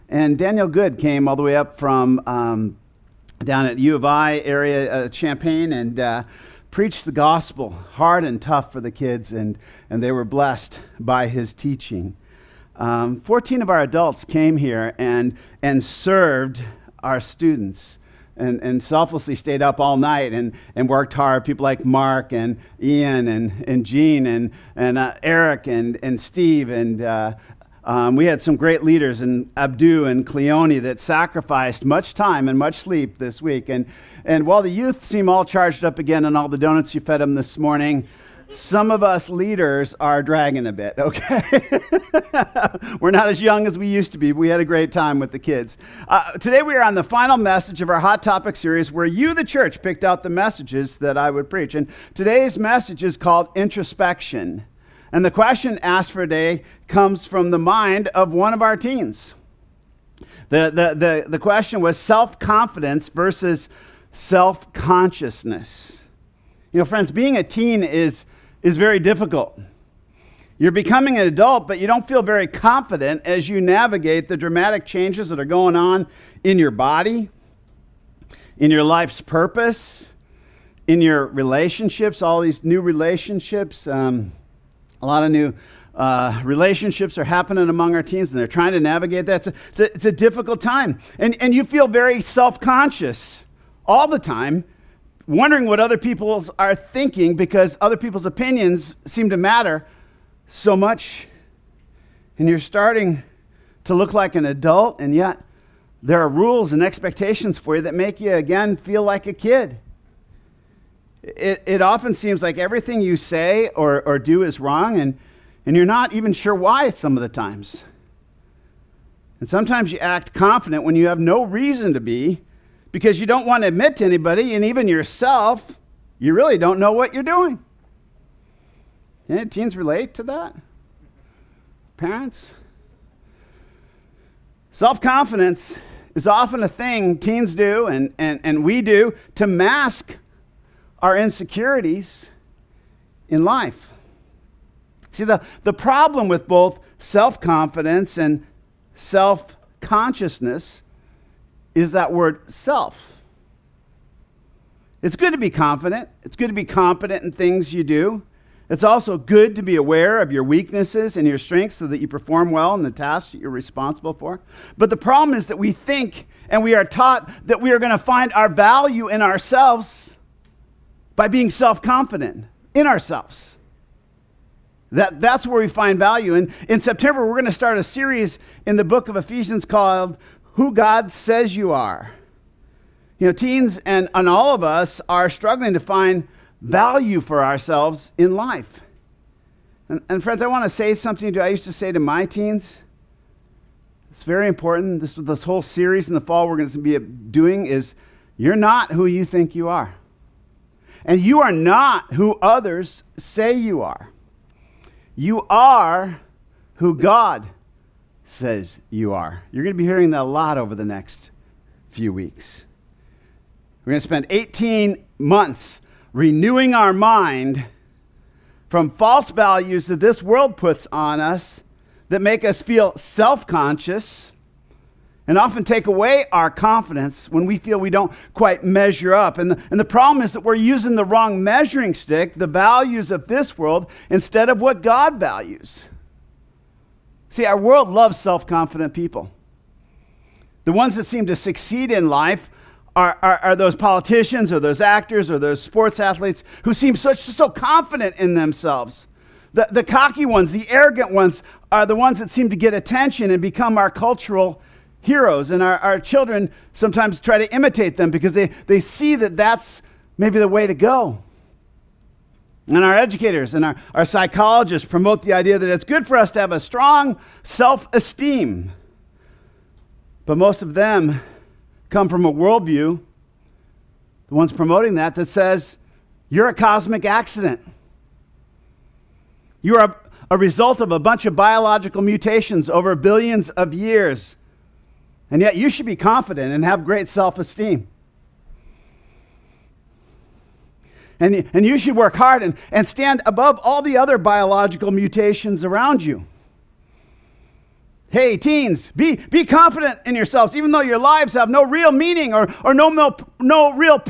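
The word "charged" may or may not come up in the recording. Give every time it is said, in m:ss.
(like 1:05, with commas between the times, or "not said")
0:35.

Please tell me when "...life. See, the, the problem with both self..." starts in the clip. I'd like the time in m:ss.
2:23.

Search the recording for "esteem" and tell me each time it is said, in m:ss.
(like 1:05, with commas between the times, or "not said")
4:27, 4:47.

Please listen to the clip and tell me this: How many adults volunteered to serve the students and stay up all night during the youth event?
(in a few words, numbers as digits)
14.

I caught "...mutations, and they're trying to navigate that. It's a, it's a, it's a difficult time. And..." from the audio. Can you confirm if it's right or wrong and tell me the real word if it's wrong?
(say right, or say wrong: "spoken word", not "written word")
wrong: "teens", not "mutations".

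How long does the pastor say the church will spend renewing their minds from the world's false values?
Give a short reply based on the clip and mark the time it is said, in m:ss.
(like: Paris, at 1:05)
18 months, at 3:34.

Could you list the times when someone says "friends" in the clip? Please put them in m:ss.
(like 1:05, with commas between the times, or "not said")
1:06, 3:10.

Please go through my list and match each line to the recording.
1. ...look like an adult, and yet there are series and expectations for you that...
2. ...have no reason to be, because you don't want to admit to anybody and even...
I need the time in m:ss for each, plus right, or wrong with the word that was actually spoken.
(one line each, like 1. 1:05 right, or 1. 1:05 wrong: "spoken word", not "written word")
1. 1:43 wrong: "rules", not "series"
2. 2:01 right.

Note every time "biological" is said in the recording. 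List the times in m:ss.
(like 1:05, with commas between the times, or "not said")
4:41, 4:54.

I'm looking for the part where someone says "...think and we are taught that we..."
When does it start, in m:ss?
2:45.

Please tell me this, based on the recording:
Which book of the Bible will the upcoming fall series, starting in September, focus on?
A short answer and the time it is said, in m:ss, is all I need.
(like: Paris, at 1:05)
Ephesians, at 2:59.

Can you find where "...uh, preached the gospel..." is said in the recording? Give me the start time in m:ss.
0:05.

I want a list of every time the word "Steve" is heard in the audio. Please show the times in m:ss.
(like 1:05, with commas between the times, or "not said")
0:26.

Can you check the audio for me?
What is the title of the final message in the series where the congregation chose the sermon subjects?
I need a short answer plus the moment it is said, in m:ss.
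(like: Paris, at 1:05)
Introspection, at 0:53.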